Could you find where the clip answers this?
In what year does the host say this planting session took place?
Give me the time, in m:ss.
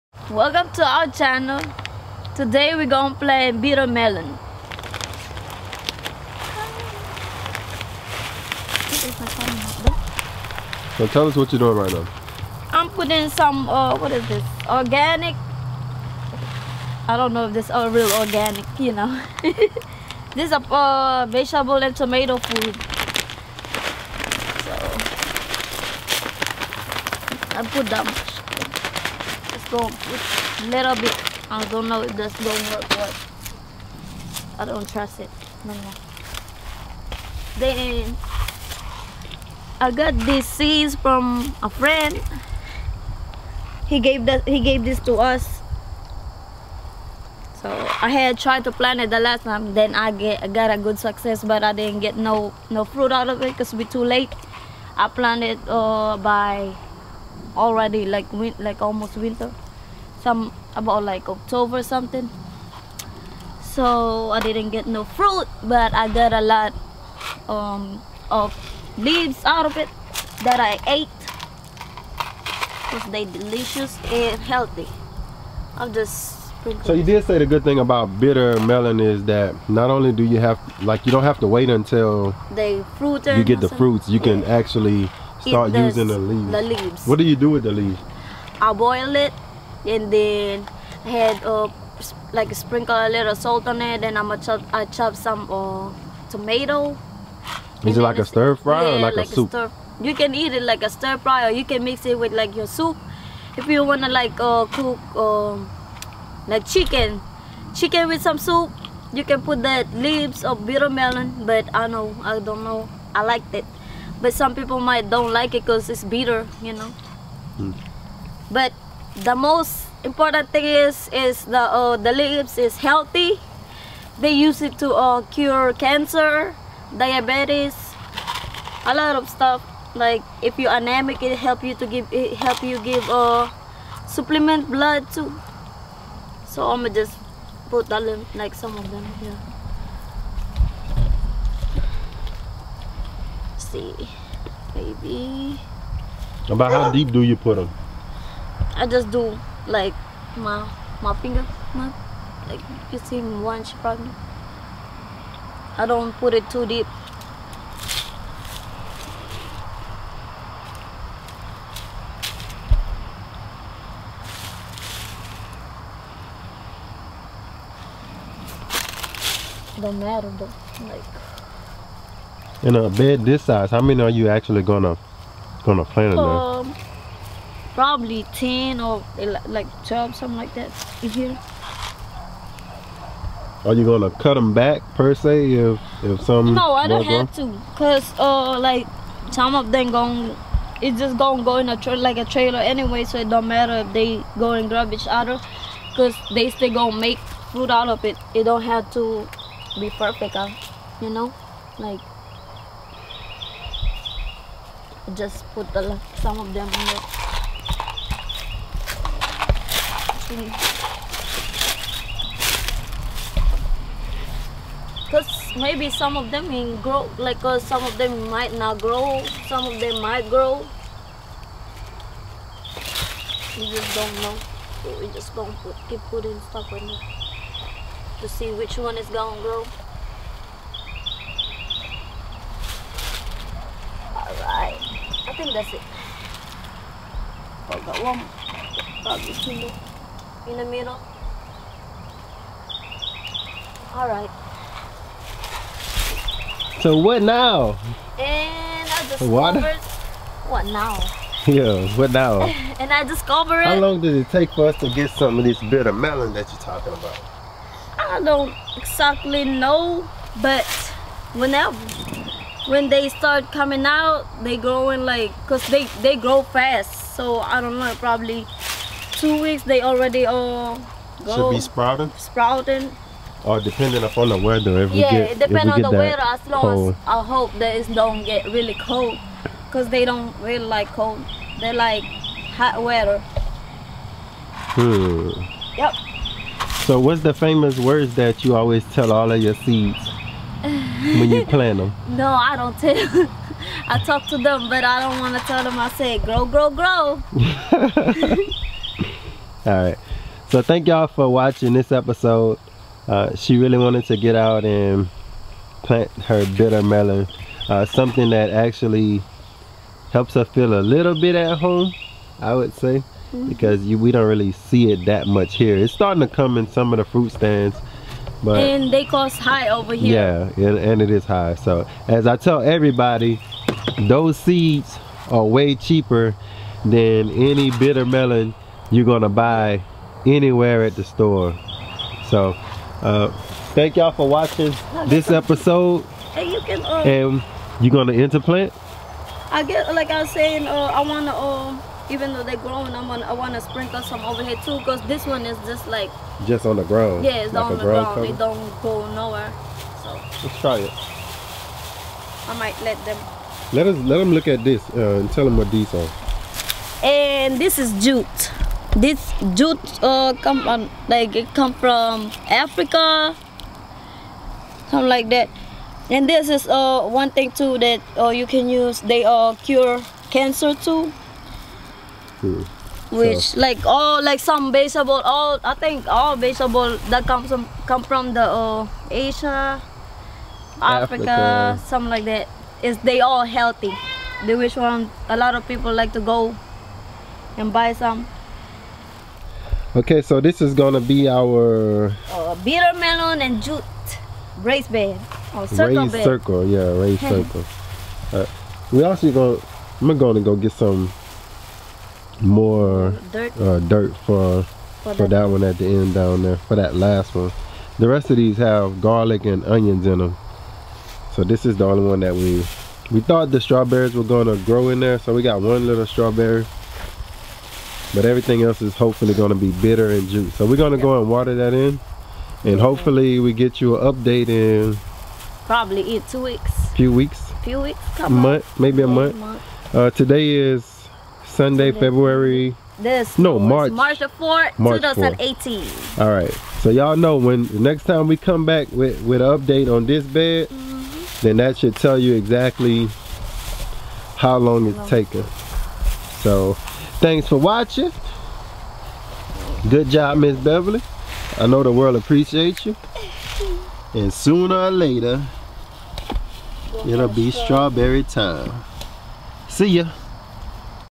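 7:14.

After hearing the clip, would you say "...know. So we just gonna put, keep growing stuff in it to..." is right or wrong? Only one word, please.
wrong.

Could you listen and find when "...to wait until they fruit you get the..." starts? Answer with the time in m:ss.
1:21.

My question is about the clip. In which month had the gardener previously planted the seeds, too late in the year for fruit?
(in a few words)
October.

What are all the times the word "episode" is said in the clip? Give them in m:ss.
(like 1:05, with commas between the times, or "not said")
5:01, 5:35.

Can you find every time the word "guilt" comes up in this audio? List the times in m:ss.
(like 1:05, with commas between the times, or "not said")
not said.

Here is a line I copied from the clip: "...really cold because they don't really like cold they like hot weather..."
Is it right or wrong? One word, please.
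right.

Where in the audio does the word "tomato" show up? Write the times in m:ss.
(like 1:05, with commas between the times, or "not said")
0:21, 1:36.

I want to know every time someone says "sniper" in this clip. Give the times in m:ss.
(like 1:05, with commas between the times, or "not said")
not said.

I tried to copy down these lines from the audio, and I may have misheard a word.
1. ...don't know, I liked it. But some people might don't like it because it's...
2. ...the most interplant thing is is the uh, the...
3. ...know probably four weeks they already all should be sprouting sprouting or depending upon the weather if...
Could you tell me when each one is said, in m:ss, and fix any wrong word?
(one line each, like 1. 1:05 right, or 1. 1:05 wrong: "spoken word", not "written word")
1. 1:52 right
2. 1:59 wrong: "important", not "interplant"
3. 4:27 wrong: "two", not "four".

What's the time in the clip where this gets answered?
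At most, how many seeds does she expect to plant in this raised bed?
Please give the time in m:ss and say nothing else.
2:59.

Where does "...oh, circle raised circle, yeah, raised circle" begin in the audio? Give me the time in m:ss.
6:35.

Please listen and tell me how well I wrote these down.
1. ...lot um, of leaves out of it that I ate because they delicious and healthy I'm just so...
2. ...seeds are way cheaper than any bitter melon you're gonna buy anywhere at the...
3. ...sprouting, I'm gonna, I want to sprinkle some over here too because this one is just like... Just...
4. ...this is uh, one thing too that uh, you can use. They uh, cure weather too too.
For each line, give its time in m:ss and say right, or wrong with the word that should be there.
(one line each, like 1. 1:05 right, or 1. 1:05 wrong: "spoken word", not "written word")
1. 1:06 right
2. 5:24 right
3. 5:42 wrong: "growing", not "sprouting"
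4. 6:06 wrong: "cancer", not "weather".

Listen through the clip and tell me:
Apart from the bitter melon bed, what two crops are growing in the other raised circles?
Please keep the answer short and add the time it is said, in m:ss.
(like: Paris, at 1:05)
Garlic and onions, at 6:49.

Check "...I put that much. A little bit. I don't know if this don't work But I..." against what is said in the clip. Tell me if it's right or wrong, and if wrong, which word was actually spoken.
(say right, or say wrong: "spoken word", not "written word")
right.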